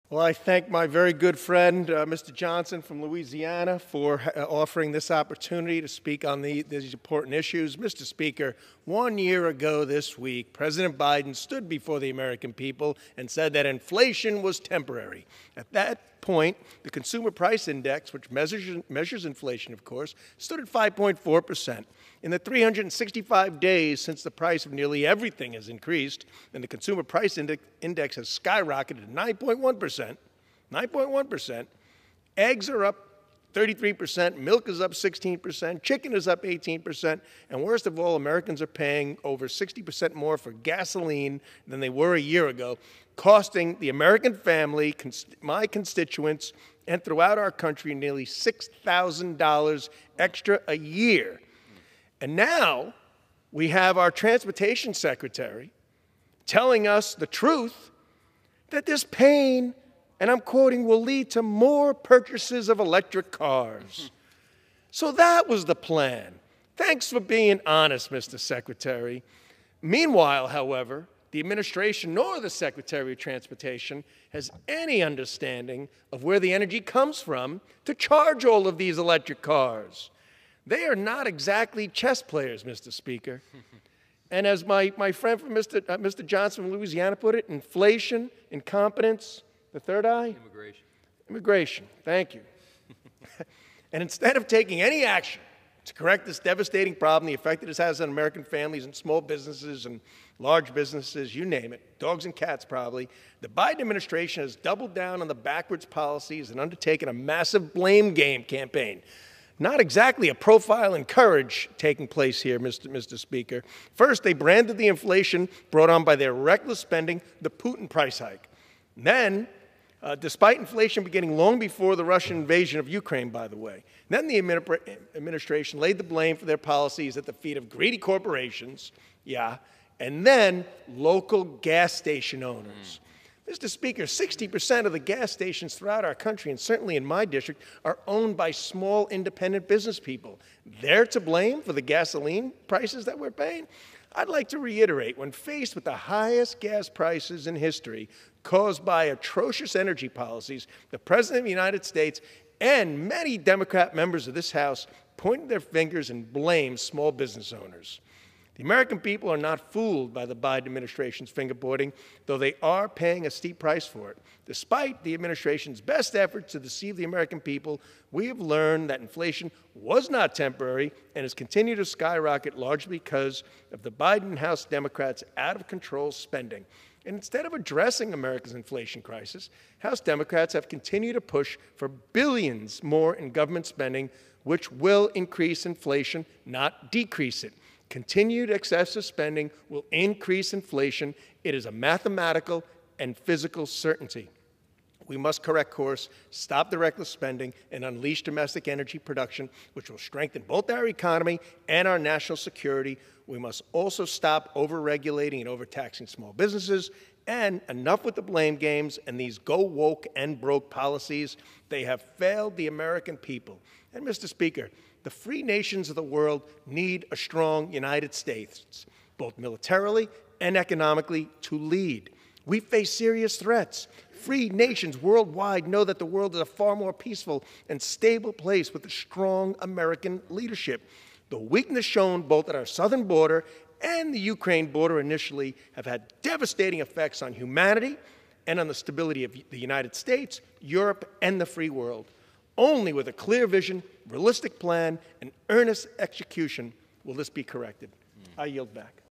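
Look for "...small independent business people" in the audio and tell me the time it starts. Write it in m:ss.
2:18.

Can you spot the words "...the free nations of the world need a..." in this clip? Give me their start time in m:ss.
3:35.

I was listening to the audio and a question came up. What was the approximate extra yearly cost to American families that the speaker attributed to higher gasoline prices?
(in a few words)
$6,000.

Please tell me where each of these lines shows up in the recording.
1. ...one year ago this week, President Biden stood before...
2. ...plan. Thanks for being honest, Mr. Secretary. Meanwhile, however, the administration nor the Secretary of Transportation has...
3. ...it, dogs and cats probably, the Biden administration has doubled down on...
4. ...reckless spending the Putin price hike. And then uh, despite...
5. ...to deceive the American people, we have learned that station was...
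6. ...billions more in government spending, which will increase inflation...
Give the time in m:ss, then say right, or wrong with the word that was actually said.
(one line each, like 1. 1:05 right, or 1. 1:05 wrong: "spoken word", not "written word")
1. 0:08 right
2. 1:05 right
3. 1:41 right
4. 1:56 right
5. 2:46 wrong: "inflation", not "station"
6. 3:01 right.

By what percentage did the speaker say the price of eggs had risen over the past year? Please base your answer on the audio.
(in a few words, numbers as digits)
33%.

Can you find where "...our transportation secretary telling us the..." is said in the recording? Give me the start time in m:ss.
0:53.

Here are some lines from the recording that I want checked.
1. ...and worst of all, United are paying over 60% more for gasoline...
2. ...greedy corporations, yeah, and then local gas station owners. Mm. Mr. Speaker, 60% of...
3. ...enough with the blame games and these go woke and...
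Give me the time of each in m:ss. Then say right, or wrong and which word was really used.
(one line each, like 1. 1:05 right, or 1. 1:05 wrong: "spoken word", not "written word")
1. 0:37 wrong: "Americans", not "United"
2. 2:07 right
3. 3:27 right.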